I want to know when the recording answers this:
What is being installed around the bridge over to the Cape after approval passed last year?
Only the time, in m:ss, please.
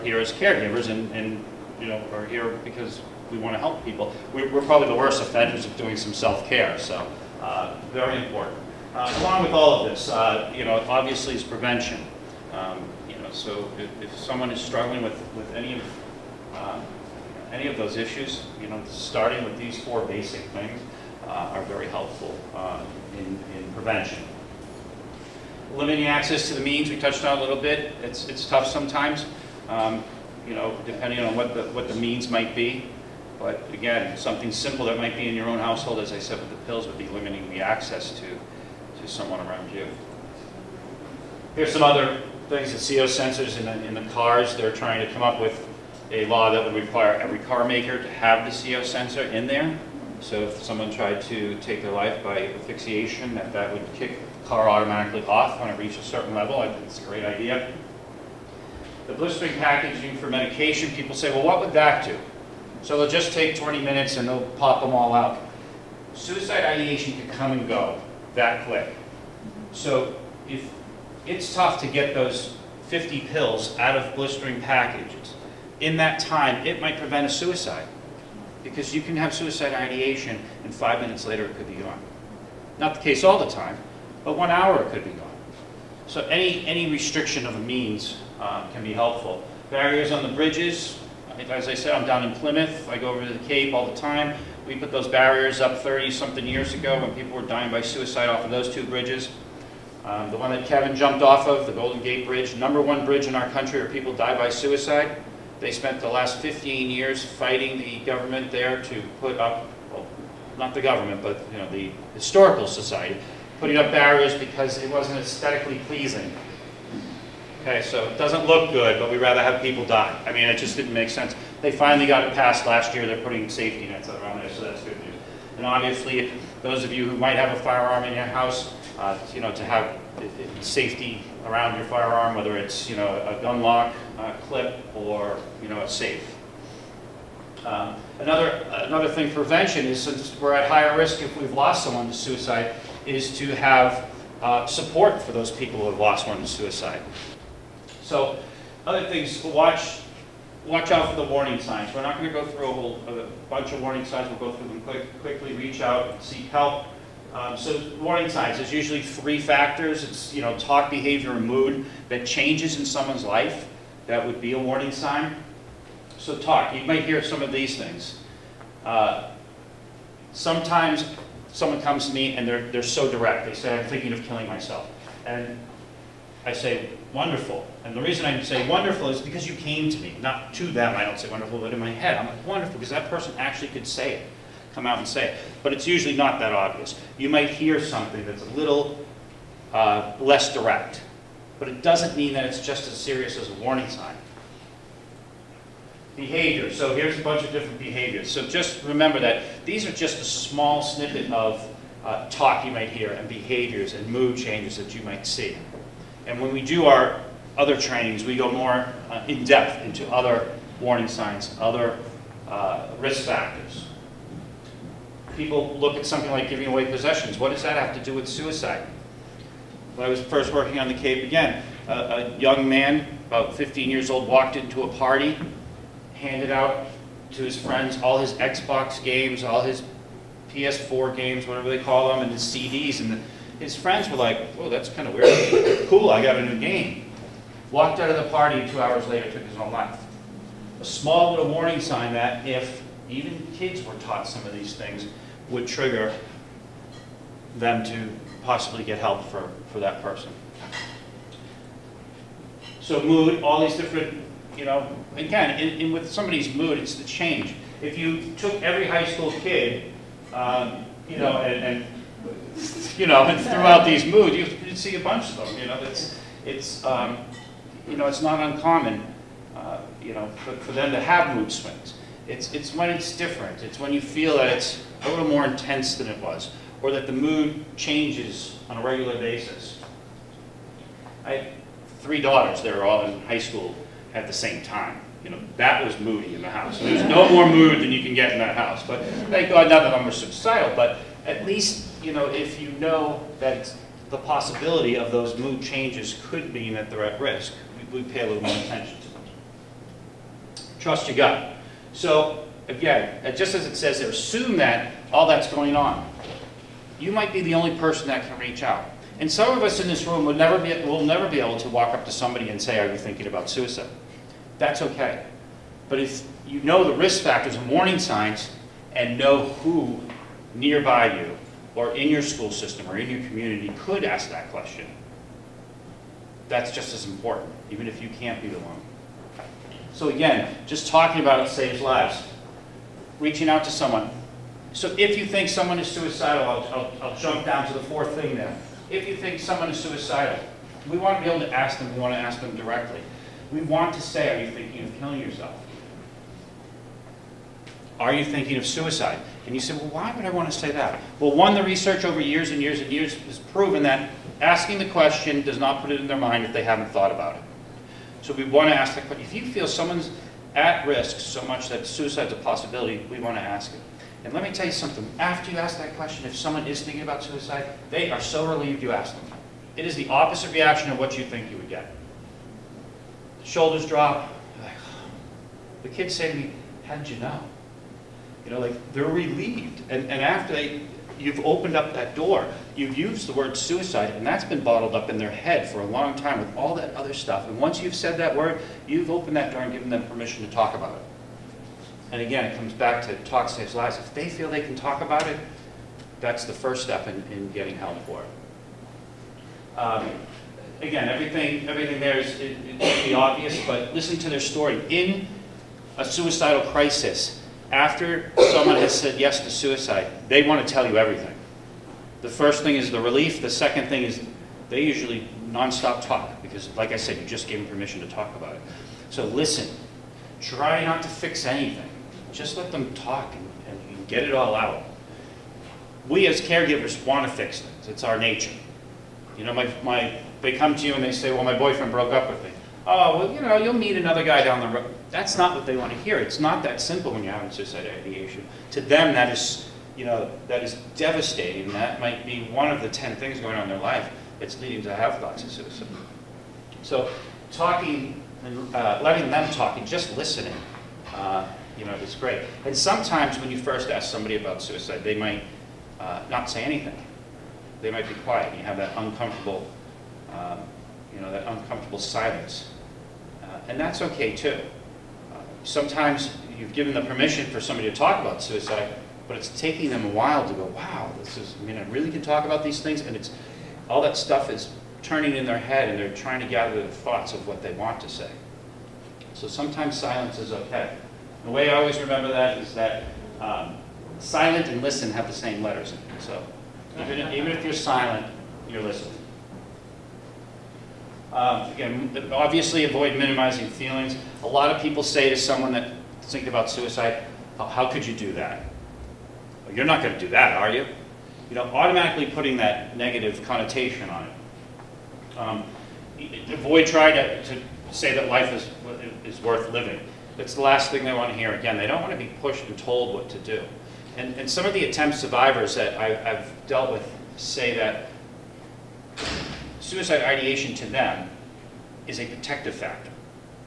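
2:03.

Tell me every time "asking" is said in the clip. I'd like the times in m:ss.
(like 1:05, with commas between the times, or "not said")
5:54.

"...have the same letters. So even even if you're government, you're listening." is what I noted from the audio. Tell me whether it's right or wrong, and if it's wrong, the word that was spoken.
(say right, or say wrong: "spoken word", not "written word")
wrong: "silent", not "government".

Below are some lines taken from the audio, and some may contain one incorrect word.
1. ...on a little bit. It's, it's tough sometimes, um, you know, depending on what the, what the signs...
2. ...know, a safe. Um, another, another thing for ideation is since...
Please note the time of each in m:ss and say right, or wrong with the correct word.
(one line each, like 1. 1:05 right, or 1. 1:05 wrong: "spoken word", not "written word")
1. 0:27 wrong: "means", not "signs"
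2. 2:15 wrong: "prevention", not "ideation".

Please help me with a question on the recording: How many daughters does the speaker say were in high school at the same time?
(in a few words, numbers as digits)
3.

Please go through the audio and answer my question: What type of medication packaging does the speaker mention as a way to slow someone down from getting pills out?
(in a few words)
Blistering packaging.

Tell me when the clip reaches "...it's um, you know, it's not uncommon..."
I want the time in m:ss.
4:26.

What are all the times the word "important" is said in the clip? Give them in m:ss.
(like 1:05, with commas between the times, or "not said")
0:08, 5:27.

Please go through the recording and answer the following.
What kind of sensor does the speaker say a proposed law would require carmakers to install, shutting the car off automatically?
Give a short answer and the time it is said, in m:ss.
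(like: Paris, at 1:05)
CO sensor, at 0:48.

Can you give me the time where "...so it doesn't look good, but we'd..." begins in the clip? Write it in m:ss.
1:57.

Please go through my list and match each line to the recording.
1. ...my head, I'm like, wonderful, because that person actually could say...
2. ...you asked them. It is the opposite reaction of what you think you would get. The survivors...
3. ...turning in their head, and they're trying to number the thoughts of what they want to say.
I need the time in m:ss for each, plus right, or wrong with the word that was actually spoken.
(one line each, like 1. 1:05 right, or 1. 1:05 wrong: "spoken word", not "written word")
1. 3:01 right
2. 6:08 wrong: "shoulders", not "survivors"
3. 7:55 wrong: "gather", not "number".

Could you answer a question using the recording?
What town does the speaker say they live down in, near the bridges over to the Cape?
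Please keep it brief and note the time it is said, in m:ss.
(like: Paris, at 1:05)
Plymouth, at 1:32.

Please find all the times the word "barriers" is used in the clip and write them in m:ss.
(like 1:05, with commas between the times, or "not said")
1:29, 1:35, 1:53.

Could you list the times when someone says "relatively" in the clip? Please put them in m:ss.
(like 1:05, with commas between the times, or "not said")
not said.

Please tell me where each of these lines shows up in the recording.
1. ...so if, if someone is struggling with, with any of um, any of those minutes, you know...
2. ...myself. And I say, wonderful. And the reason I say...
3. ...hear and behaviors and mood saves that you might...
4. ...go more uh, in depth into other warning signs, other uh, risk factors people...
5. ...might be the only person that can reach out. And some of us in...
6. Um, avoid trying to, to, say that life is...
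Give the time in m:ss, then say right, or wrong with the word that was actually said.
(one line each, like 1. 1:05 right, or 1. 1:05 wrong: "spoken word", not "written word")
1. 0:13 wrong: "issues", not "minutes"
2. 2:54 right
3. 3:22 wrong: "changes", not "saves"
4. 3:28 right
5. 5:07 right
6. 8:25 right.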